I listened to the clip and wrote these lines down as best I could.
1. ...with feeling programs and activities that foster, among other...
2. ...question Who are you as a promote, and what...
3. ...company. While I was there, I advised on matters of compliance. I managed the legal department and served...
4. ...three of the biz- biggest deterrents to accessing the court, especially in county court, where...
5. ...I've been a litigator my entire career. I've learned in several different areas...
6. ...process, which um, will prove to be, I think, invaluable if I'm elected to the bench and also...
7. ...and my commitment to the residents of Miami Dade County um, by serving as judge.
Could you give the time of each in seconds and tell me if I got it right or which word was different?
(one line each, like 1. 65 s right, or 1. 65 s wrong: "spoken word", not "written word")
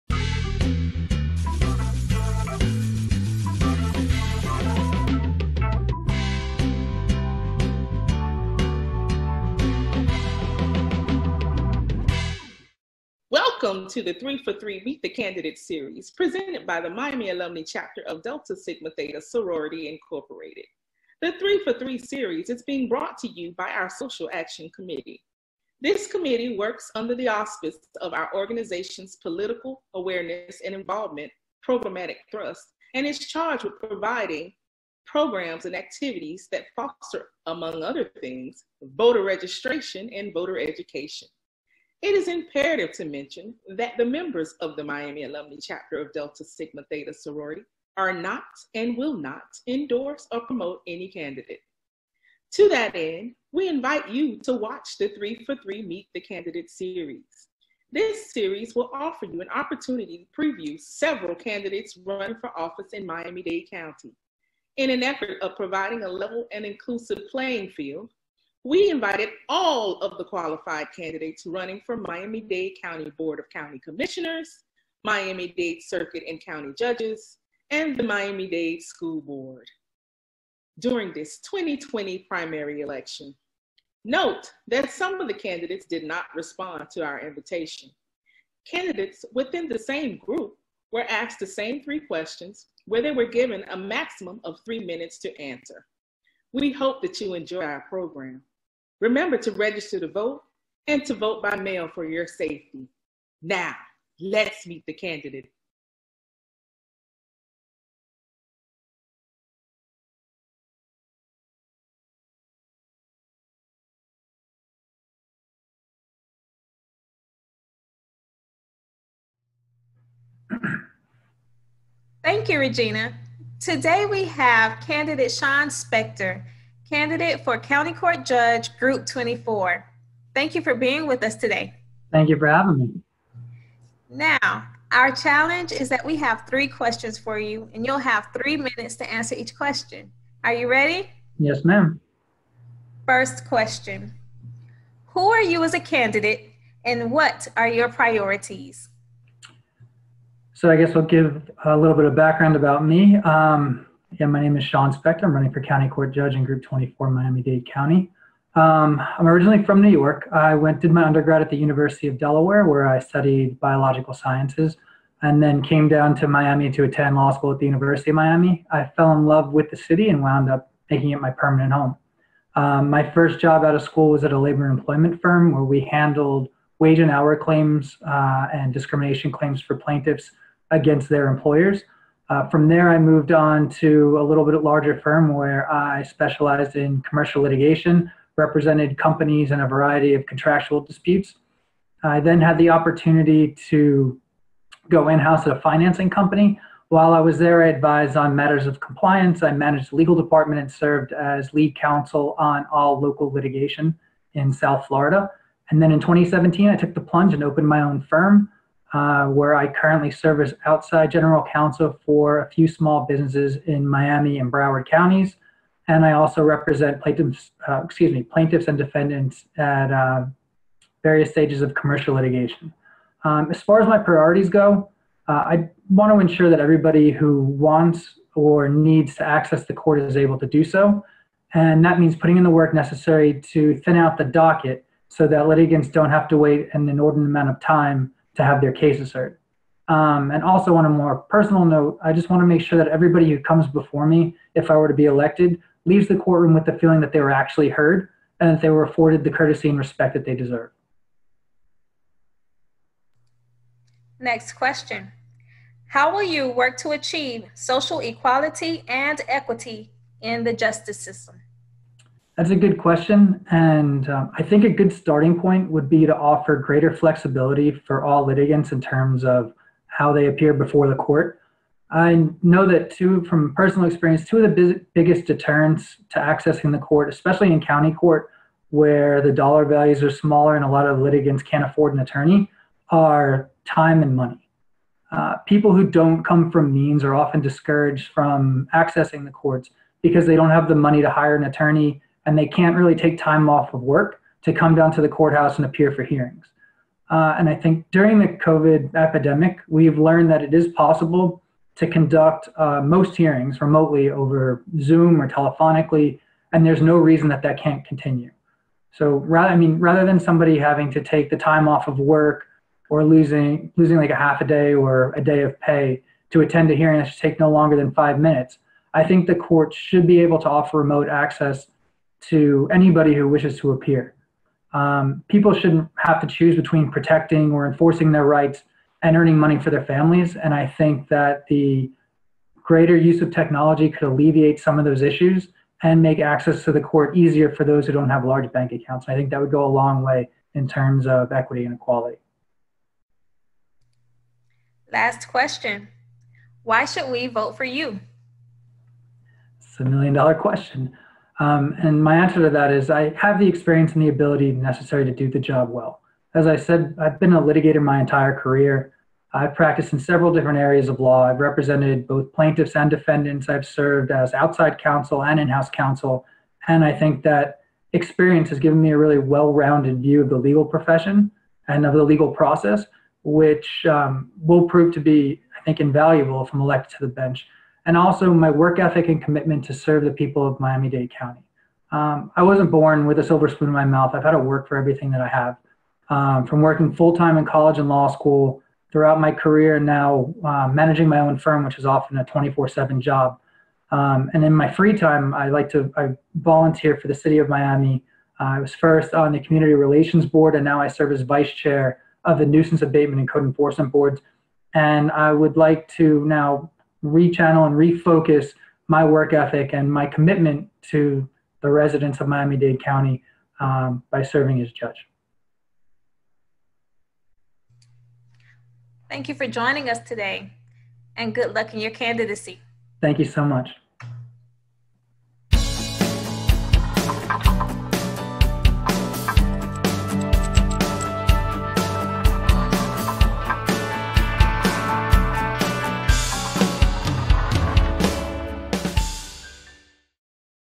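1. 33 s wrong: "providing", not "feeling"
2. 143 s wrong: "candidate", not "promote"
3. 196 s right
4. 274 s wrong: "two", not "three"
5. 357 s wrong: "practiced", not "learned"
6. 372 s right
7. 409 s right.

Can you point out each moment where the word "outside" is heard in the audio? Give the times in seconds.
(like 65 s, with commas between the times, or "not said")
210 s, 364 s.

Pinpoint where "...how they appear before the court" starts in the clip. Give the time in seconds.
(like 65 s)
269 s.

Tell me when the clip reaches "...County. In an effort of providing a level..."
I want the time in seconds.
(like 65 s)
63 s.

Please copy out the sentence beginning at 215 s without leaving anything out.
And I also represent plaintiffs, uh, excuse me, plaintiffs and defendants at uh, various stages of commercial litigation.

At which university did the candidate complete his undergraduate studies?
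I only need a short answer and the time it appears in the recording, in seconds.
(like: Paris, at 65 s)
University of Delaware, at 161 s.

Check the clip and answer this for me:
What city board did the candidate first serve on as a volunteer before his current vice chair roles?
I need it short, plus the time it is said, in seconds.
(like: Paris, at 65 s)
Community Relations Board, at 399 s.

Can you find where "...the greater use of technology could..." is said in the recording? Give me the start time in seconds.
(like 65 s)
331 s.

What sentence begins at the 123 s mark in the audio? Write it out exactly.
Today we have candidate Shaun Spector candidate for County Court Judge Group 24.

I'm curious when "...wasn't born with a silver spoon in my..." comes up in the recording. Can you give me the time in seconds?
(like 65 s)
382 s.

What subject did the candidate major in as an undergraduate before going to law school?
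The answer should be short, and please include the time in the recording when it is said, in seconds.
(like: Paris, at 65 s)
Biological sciences, at 163 s.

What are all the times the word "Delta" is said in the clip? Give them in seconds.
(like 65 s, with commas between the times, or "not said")
18 s, 46 s.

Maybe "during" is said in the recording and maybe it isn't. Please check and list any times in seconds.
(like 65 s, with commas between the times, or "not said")
80 s, 297 s.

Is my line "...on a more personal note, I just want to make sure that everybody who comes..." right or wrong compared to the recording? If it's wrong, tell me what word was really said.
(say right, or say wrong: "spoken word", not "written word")
right.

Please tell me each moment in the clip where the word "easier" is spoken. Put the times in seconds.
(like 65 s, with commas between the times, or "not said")
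337 s.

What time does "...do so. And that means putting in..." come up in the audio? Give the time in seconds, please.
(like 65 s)
230 s.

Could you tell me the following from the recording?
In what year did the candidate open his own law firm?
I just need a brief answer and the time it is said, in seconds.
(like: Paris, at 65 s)
2017, at 205 s.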